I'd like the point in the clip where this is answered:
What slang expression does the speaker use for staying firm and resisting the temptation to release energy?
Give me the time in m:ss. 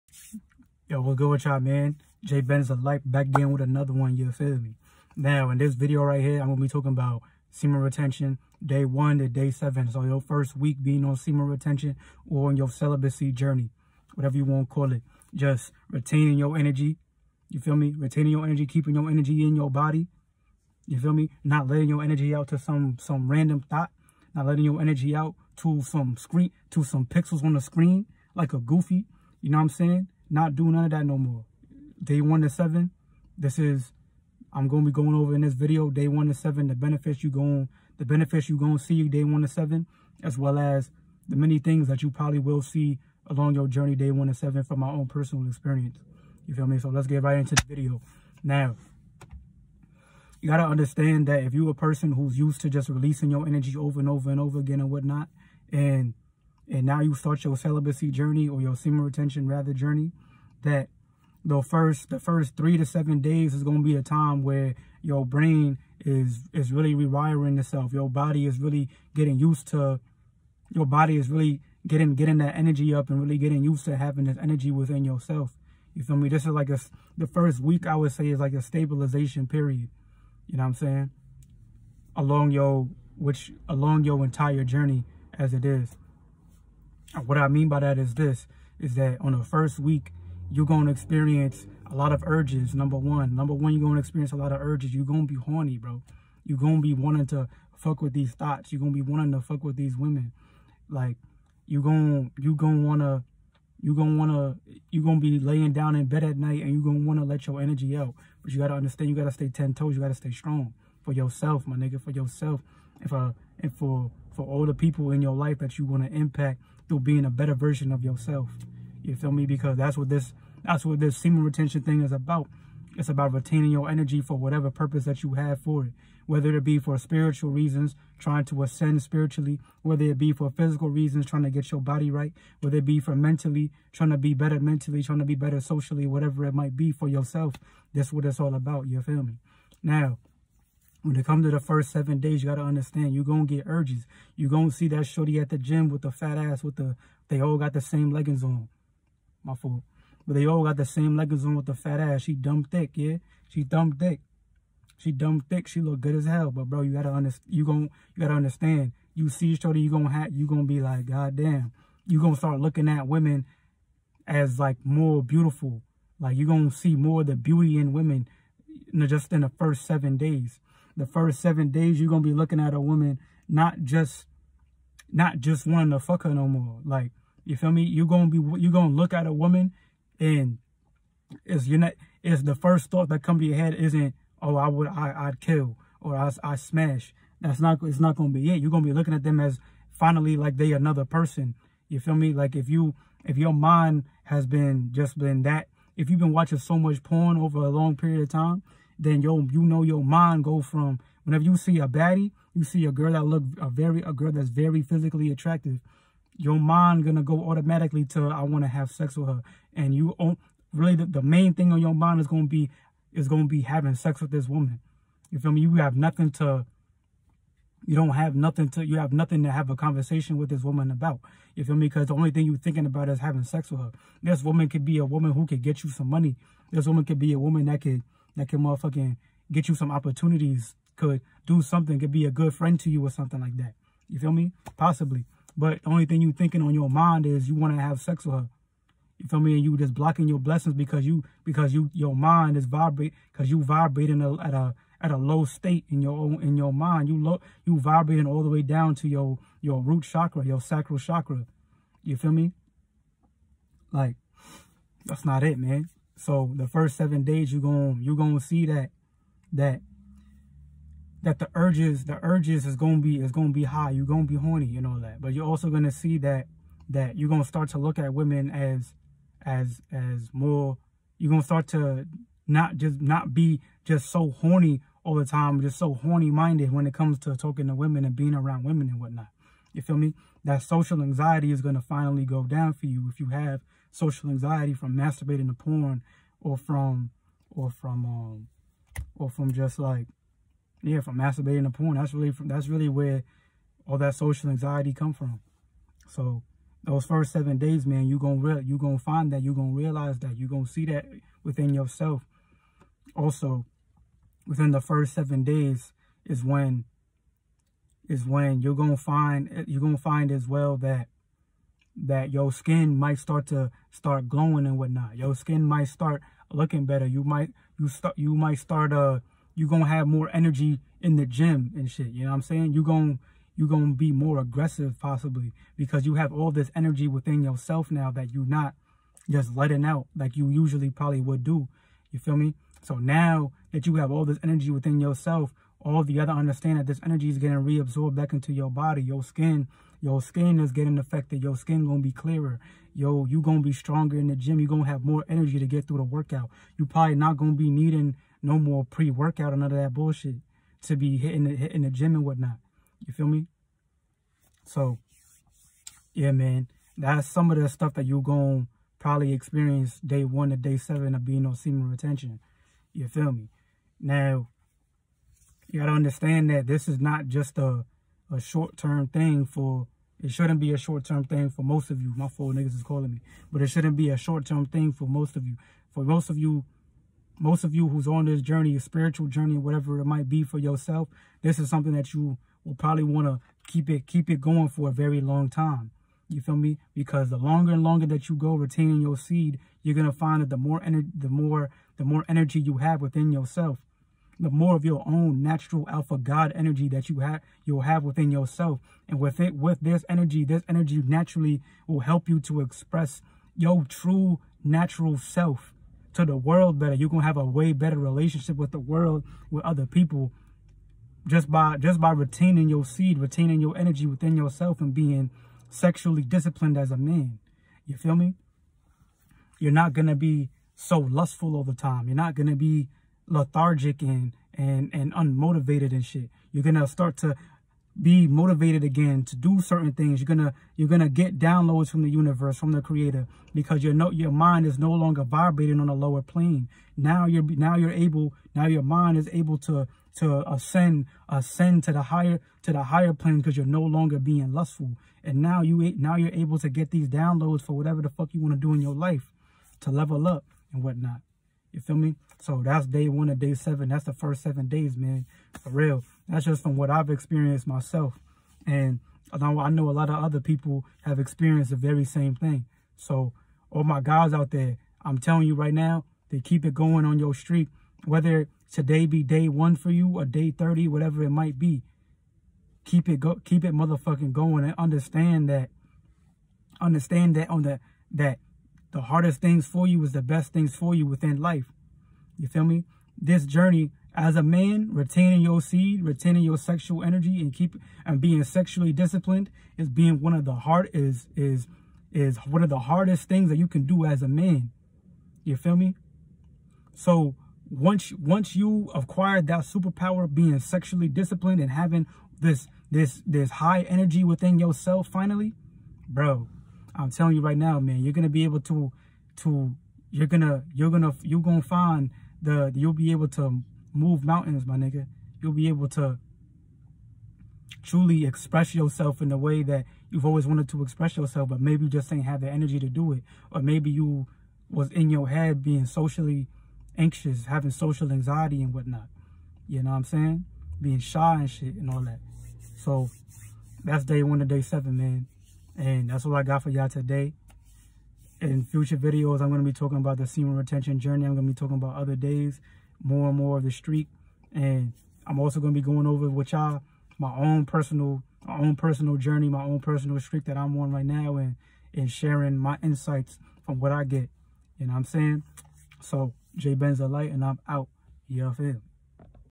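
1:49.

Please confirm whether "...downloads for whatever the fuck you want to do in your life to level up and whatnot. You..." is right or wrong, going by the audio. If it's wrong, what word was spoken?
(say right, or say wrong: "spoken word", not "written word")
right.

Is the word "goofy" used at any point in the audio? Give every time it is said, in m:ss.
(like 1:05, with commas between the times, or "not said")
0:28.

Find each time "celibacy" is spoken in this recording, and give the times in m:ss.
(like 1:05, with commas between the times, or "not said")
0:12, 0:57.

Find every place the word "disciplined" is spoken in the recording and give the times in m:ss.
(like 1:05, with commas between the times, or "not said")
6:56, 8:08, 8:21.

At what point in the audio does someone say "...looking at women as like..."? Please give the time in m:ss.
2:42.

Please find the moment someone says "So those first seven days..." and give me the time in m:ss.
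4:56.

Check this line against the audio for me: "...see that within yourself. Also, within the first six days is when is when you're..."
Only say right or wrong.
wrong.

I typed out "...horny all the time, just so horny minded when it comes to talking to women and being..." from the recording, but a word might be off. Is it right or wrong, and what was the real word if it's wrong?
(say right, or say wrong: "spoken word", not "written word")
right.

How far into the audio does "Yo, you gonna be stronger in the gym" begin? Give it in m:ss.
5:42.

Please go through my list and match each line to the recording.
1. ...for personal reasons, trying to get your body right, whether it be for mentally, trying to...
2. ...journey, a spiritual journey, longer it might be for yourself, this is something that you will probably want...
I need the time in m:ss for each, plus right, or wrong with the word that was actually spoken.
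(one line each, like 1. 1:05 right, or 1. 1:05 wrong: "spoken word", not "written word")
1. 2:10 wrong: "physical", not "personal"
2. 6:18 wrong: "whatever", not "longer".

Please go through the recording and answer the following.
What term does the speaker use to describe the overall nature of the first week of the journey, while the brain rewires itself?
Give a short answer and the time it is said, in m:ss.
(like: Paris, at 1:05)
stabilization period, at 1:18.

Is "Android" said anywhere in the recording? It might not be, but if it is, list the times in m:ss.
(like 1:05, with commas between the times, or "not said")
not said.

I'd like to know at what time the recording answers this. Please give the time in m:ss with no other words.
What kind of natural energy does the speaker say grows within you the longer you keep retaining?
6:35.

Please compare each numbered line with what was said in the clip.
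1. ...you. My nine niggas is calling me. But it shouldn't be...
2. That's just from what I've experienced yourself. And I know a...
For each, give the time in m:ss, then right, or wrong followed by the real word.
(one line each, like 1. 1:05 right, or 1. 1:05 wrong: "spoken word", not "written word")
1. 6:12 wrong: "four", not "nine"
2. 7:36 wrong: "myself", not "yourself".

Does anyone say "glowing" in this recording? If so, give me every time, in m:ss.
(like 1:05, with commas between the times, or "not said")
5:14.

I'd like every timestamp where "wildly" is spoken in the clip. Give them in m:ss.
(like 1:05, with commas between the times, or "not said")
not said.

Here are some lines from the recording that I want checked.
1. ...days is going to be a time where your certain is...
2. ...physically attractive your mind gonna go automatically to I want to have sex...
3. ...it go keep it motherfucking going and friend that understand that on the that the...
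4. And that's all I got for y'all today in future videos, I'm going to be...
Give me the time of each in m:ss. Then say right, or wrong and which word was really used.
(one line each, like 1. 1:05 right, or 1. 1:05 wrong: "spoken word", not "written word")
1. 1:03 wrong: "brain", not "certain"
2. 3:24 right
3. 7:53 wrong: "understand", not "friend"
4. 8:55 right.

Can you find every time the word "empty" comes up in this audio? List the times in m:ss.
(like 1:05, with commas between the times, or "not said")
not said.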